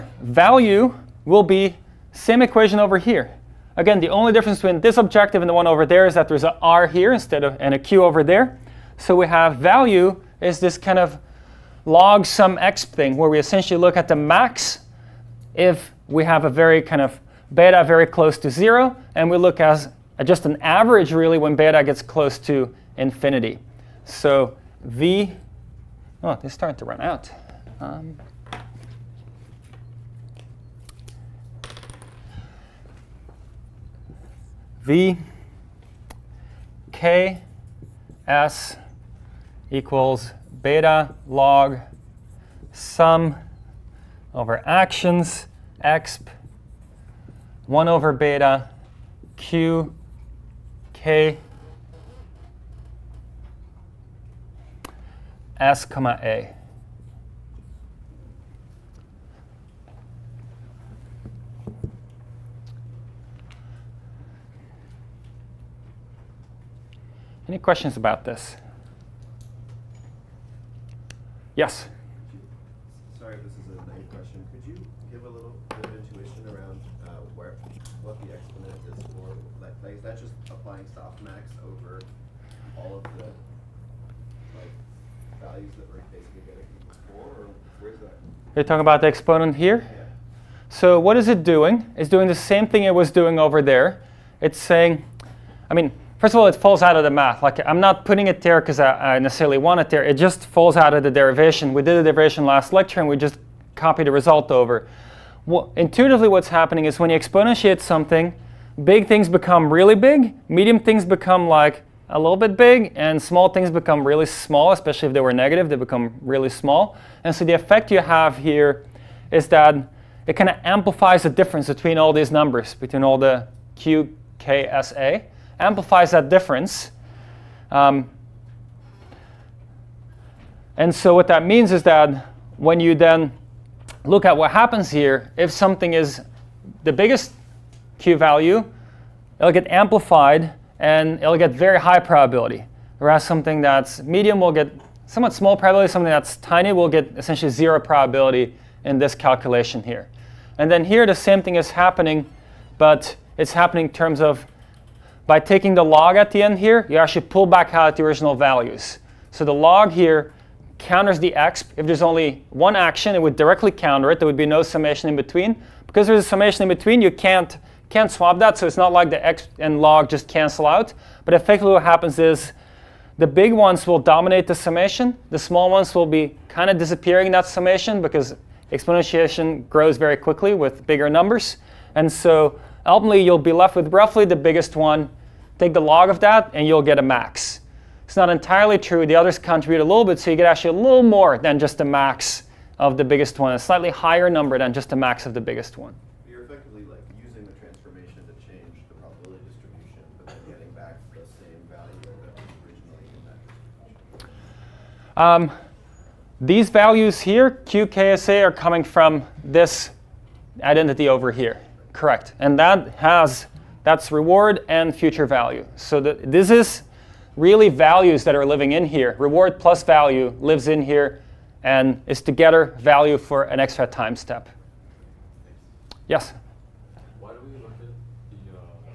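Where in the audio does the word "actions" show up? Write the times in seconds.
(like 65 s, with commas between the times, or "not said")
44 s, 162 s.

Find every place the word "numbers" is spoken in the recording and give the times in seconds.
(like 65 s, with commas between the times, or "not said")
122 s, 181 s, 194 s.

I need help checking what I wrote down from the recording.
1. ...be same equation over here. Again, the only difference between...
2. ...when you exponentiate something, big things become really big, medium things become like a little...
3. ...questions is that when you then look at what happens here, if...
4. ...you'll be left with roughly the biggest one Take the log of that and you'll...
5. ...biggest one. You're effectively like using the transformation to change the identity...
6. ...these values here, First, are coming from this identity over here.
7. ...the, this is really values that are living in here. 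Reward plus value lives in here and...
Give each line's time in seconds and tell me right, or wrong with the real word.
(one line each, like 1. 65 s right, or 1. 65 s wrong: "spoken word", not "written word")
1. 1 s right
2. 106 s right
3. 131 s wrong: "means", not "questions"
4. 183 s right
5. 195 s wrong: "probability", not "identity"
6. 206 s wrong: "QKSA", not "First"
7. 215 s right.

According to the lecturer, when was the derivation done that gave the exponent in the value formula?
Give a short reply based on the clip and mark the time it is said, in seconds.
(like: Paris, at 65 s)
last lecture, at 102 s.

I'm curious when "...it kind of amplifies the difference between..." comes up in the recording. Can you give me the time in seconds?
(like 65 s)
120 s.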